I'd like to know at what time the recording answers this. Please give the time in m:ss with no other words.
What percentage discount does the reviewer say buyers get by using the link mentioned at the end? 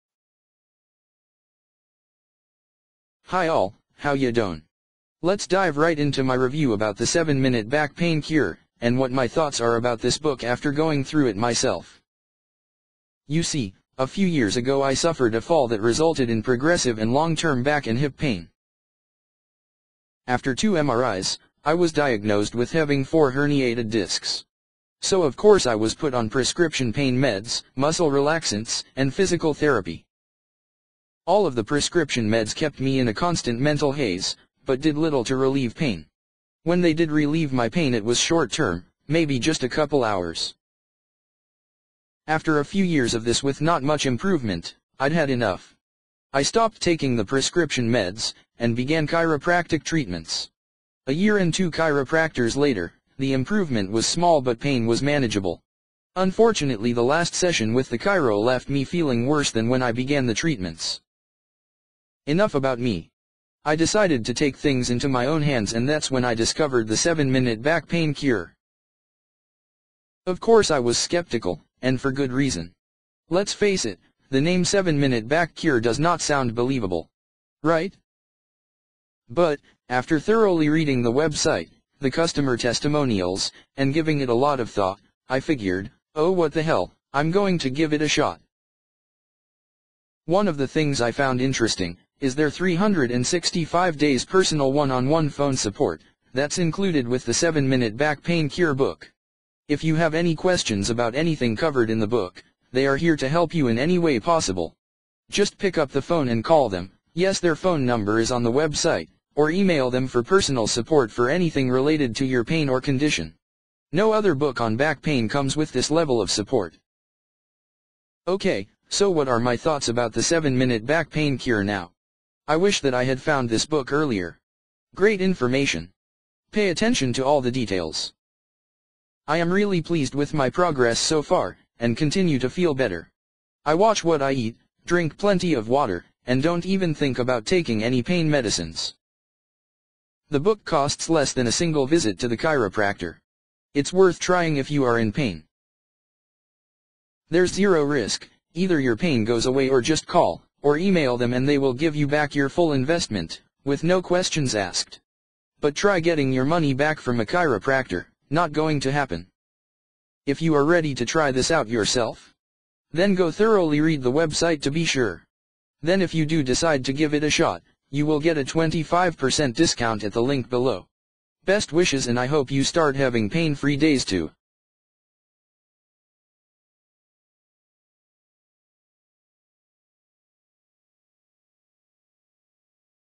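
2:48.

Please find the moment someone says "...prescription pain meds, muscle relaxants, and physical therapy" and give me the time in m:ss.
0:26.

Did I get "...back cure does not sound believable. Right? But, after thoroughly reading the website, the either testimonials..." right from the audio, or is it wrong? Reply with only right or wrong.
wrong.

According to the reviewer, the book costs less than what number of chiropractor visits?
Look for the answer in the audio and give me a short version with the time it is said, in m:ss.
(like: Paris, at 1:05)
a single visit, at 2:21.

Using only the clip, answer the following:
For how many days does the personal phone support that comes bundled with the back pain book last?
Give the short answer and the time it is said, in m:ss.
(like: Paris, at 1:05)
365 days, at 1:32.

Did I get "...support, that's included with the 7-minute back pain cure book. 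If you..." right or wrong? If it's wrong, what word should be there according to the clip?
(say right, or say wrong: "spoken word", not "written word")
right.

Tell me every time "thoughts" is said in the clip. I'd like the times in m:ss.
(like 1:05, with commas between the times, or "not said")
0:09, 1:24, 1:59.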